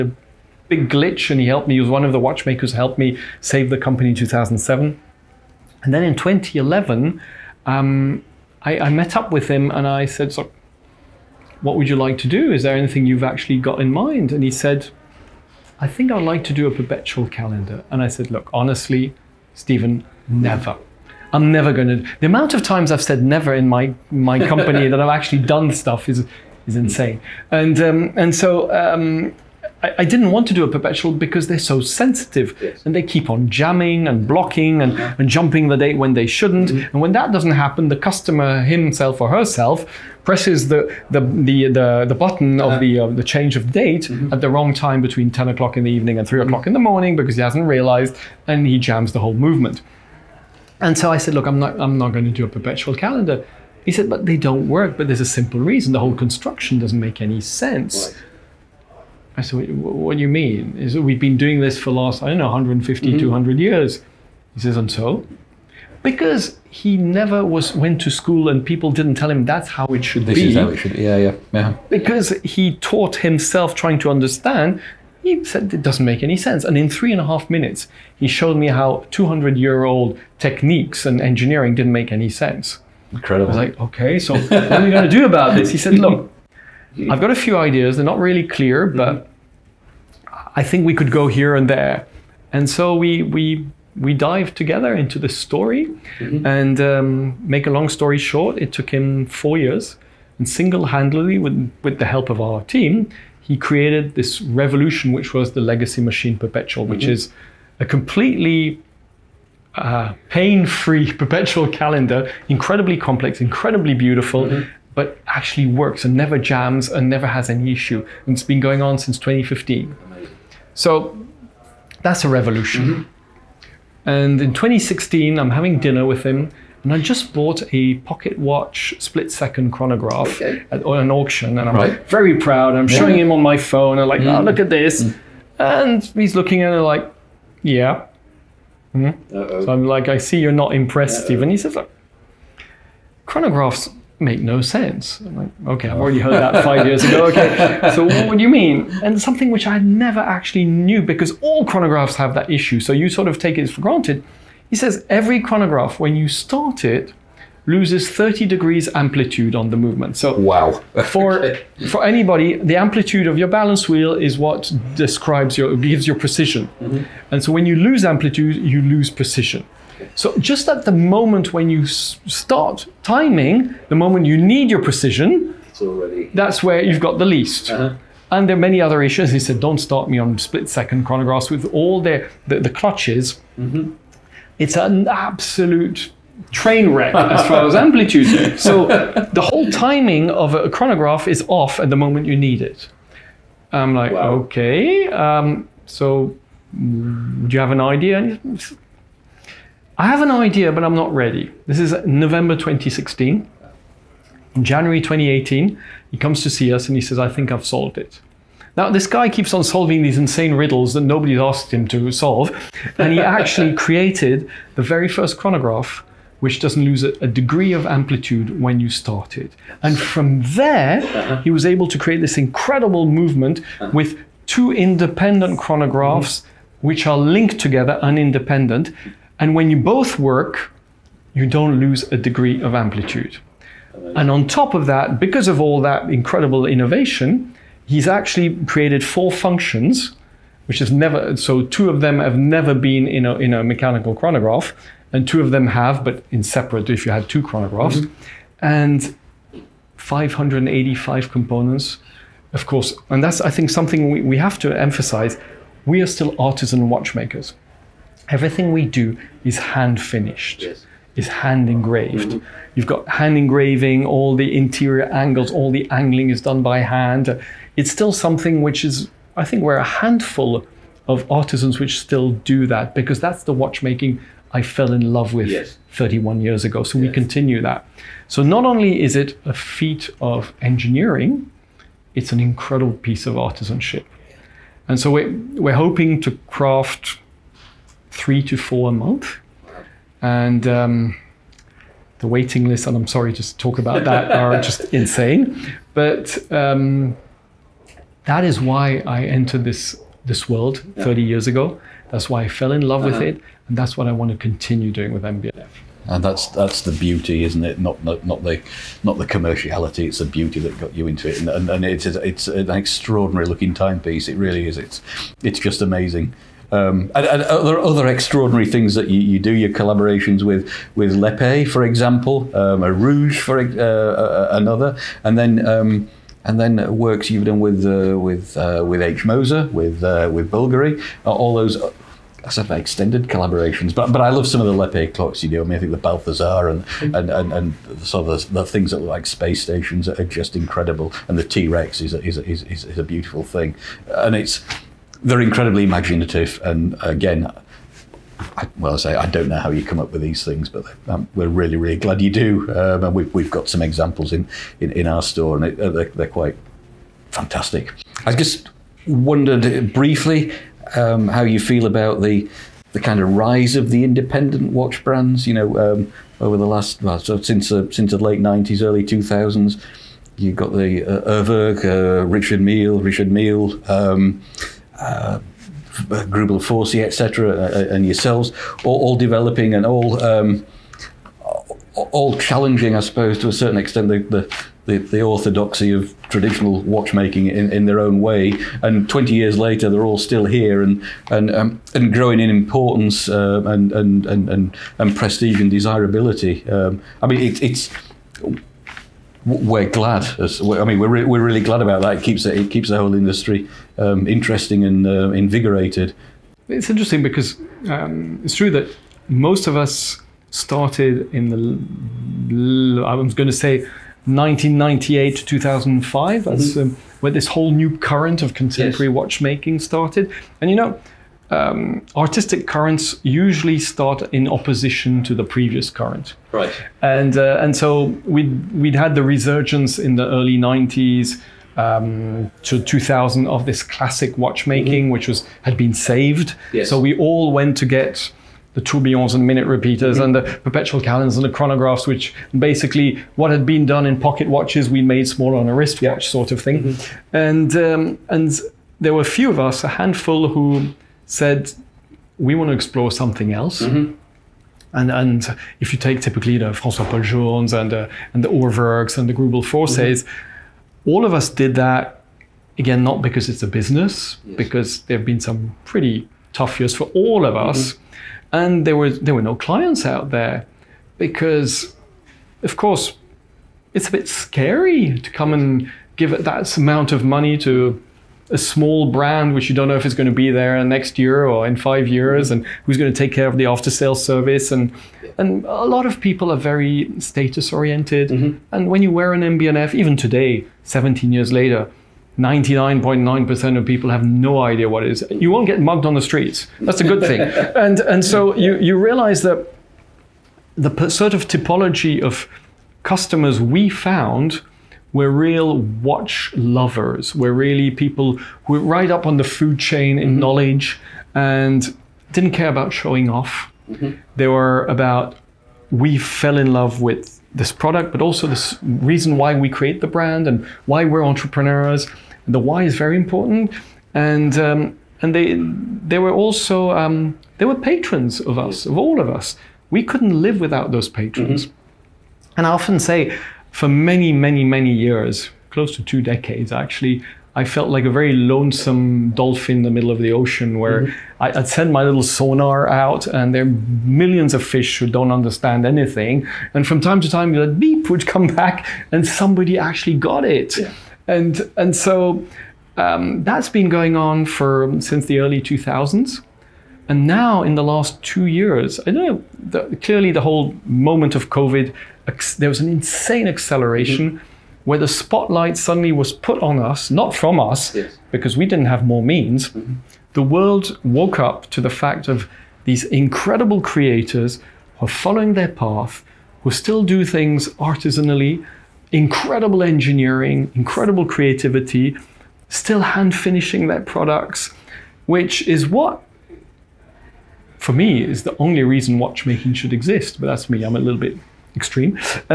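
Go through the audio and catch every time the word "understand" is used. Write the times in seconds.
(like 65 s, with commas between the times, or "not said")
74 s, 545 s.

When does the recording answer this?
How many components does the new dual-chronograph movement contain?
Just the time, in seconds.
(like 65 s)
249 s.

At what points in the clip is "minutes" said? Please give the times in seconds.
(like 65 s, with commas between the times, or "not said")
77 s, 439 s.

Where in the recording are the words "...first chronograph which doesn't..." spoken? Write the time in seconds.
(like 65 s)
215 s.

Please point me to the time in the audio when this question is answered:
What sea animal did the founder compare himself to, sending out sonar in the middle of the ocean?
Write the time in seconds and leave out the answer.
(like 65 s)
539 s.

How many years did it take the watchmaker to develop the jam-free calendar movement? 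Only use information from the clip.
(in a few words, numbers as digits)
4.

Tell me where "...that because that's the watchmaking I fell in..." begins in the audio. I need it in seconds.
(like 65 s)
272 s.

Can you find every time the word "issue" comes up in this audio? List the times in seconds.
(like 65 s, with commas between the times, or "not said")
117 s, 152 s, 179 s.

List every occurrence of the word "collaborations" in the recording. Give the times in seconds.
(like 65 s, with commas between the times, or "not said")
319 s, 333 s.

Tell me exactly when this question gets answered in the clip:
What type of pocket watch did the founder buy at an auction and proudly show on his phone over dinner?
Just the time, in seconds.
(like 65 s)
128 s.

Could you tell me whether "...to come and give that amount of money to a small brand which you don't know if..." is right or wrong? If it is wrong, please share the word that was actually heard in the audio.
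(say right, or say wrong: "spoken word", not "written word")
right.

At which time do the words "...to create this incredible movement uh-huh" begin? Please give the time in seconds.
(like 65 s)
221 s.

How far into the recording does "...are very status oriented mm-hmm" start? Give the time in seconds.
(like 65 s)
486 s.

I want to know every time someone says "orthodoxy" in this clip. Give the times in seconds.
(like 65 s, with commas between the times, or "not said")
385 s.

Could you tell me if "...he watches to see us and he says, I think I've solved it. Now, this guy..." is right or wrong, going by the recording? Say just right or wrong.
wrong.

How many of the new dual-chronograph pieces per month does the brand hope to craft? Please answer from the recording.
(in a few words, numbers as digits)
3 to 4.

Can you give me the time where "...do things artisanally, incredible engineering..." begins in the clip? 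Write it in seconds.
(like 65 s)
577 s.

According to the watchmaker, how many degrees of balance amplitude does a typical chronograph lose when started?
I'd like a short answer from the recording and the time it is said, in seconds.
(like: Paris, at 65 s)
30, at 158 s.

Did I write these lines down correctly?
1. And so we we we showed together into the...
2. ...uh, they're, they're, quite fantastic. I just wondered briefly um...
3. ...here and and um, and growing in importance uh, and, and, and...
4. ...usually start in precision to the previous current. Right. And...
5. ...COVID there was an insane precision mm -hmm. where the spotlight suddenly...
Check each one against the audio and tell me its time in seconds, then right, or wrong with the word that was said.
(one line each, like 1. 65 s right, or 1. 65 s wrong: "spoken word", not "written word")
1. 92 s wrong: "dived", not "showed"
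2. 355 s right
3. 390 s right
4. 423 s wrong: "opposition", not "precision"
5. 561 s wrong: "acceleration", not "precision".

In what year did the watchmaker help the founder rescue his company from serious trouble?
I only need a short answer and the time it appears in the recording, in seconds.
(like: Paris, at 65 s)
2007, at 4 s.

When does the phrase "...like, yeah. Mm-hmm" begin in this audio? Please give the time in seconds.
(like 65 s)
136 s.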